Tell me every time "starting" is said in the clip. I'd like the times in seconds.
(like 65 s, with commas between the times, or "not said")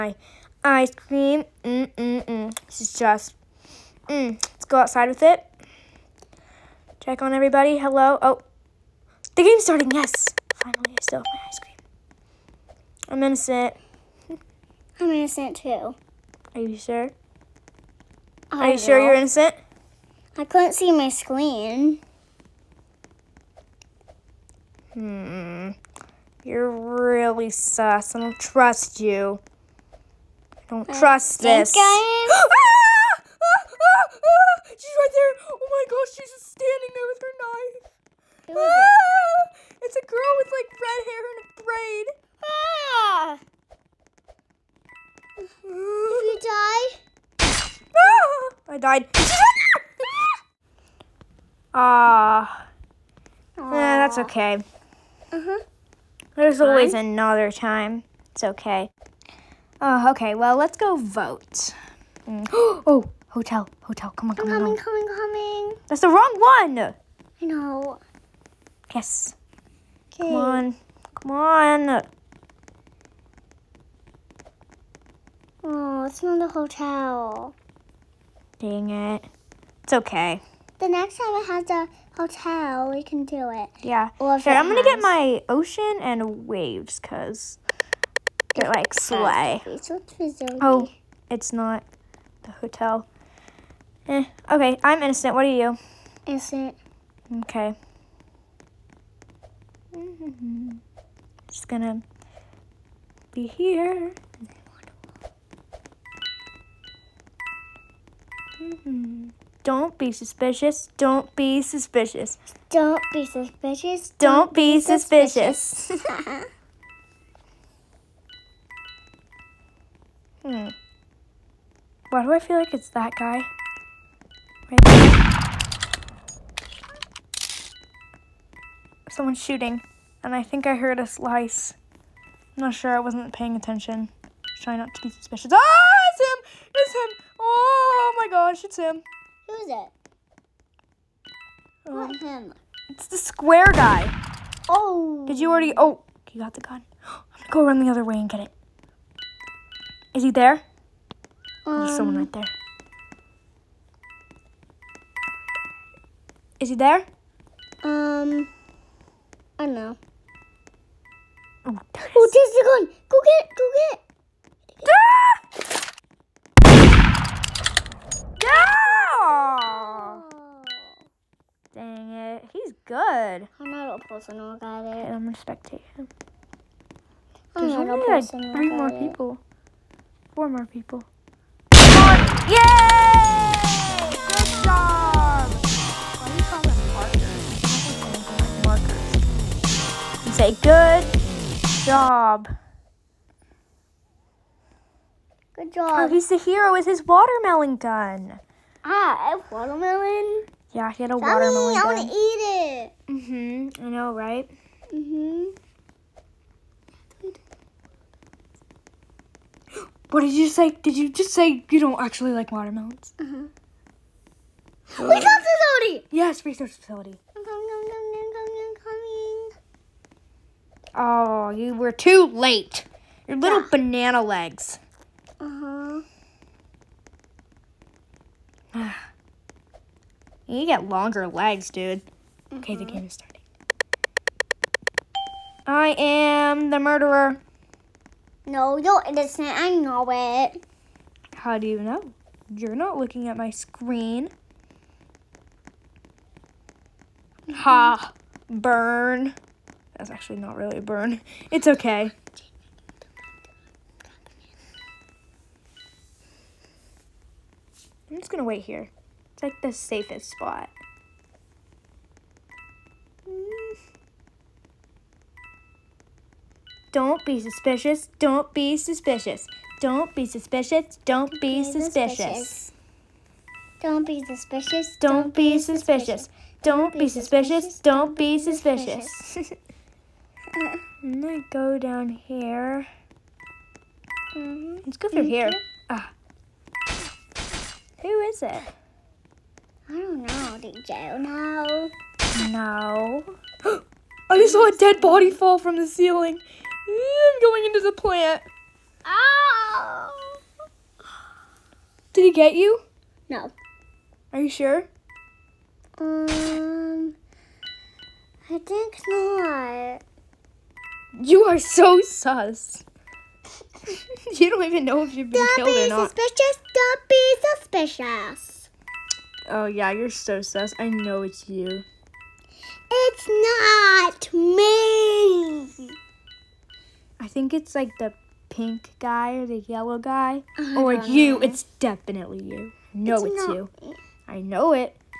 9 s, 233 s.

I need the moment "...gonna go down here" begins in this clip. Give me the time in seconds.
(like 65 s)
281 s.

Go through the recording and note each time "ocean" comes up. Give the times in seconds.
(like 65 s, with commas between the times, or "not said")
85 s.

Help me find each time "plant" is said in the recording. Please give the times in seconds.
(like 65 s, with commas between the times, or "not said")
297 s.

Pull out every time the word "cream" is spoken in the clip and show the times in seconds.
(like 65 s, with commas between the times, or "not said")
0 s, 11 s.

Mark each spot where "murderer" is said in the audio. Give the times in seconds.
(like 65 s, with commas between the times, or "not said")
236 s.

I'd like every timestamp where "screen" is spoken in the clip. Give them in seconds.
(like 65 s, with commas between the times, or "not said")
21 s, 243 s.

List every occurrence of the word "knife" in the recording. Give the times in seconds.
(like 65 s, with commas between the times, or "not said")
37 s.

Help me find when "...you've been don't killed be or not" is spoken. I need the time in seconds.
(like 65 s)
315 s.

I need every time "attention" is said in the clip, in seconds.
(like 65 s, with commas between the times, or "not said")
133 s.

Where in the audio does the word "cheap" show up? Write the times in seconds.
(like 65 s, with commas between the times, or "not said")
not said.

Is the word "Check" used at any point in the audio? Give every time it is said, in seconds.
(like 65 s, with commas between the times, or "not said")
6 s.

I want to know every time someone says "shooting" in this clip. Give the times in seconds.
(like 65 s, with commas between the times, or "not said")
129 s.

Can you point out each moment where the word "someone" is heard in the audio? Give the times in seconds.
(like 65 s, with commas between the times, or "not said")
129 s, 151 s.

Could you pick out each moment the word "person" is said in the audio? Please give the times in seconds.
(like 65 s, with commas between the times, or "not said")
174 s.